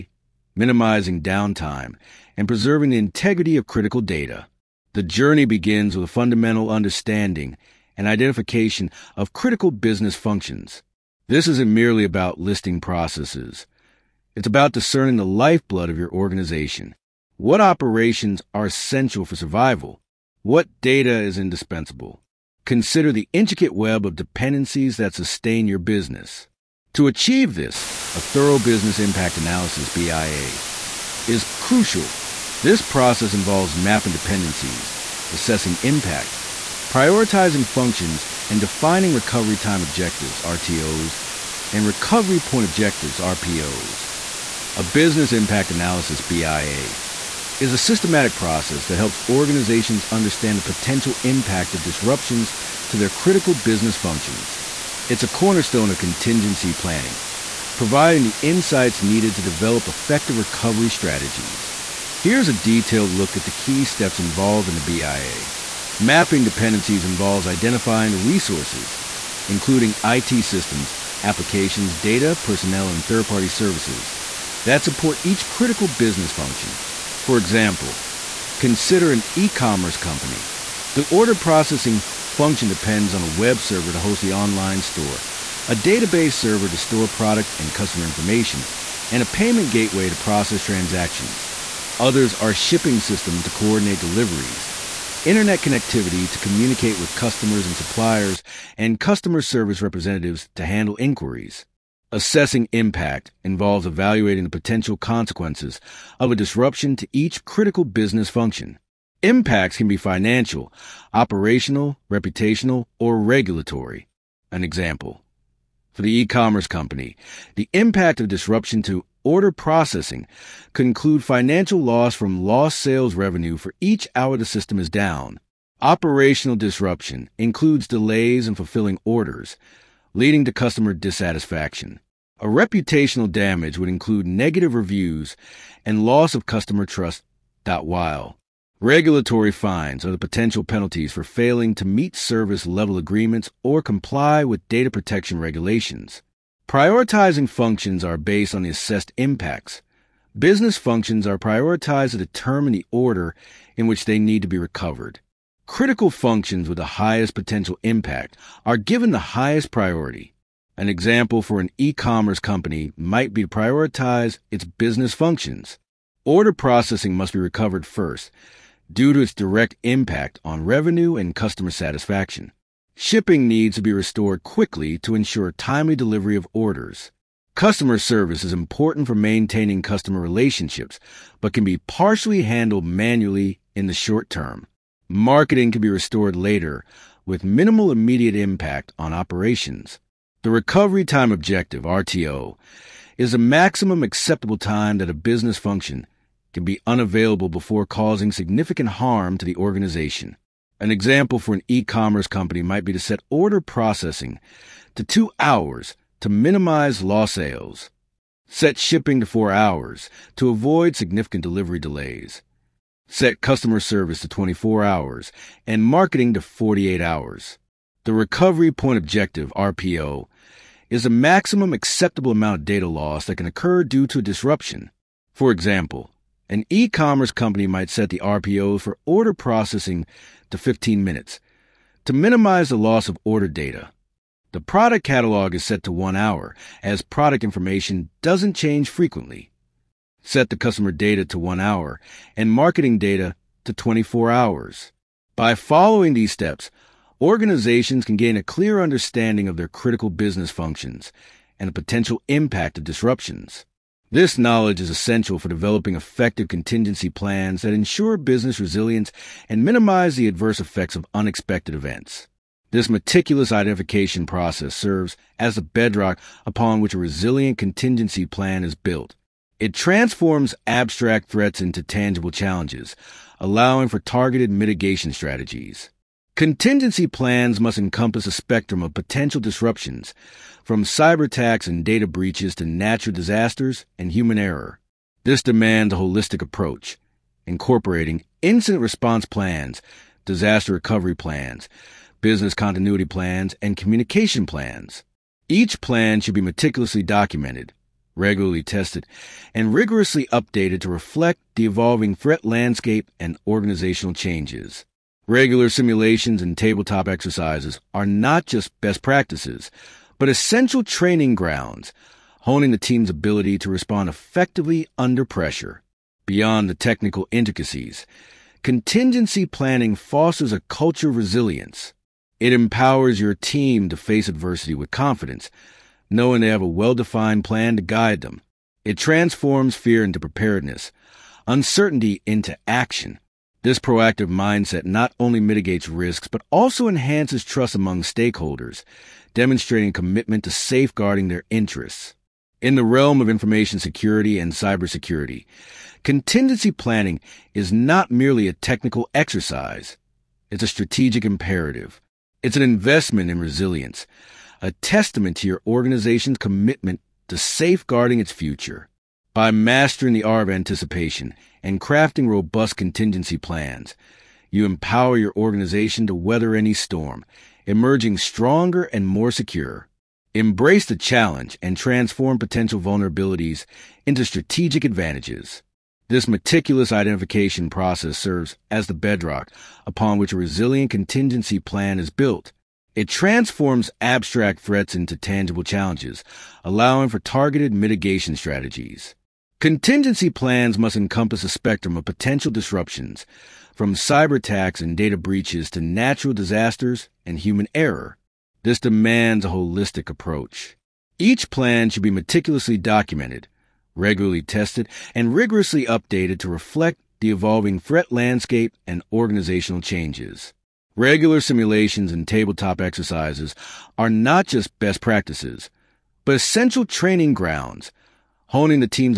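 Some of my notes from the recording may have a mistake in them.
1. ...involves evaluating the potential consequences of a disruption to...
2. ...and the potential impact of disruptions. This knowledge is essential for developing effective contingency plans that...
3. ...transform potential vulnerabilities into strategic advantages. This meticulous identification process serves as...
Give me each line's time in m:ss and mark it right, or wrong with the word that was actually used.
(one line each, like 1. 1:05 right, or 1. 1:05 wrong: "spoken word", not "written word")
1. 1:43 right
2. 4:11 right
3. 6:11 right.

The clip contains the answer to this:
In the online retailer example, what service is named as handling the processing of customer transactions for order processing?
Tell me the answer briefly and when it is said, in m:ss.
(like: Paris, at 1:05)
Payment gateway, at 1:29.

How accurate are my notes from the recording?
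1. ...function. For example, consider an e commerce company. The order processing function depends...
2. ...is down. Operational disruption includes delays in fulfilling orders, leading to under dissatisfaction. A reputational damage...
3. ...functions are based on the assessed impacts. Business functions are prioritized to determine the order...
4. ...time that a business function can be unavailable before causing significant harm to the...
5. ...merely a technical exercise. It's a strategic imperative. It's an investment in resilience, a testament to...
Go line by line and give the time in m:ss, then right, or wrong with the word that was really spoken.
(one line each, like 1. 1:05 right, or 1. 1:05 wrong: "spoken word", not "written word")
1. 1:16 right
2. 2:04 wrong: "customer", not "under"
3. 2:27 right
4. 3:14 right
5. 5:48 right.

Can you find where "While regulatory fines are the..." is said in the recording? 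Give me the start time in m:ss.
2:17.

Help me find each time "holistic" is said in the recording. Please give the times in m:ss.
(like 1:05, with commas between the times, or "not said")
4:45, 6:39.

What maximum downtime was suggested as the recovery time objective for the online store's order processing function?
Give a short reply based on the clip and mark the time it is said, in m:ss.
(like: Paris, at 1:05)
2 hours, at 3:25.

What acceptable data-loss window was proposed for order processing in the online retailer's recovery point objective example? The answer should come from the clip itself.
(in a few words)
15 minutes.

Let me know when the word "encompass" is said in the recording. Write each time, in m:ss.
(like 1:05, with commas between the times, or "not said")
4:37, 6:30.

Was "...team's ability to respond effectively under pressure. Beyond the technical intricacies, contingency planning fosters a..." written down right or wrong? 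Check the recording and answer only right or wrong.
right.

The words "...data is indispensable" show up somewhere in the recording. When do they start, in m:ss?
0:20.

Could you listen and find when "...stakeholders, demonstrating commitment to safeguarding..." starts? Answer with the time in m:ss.
5:38.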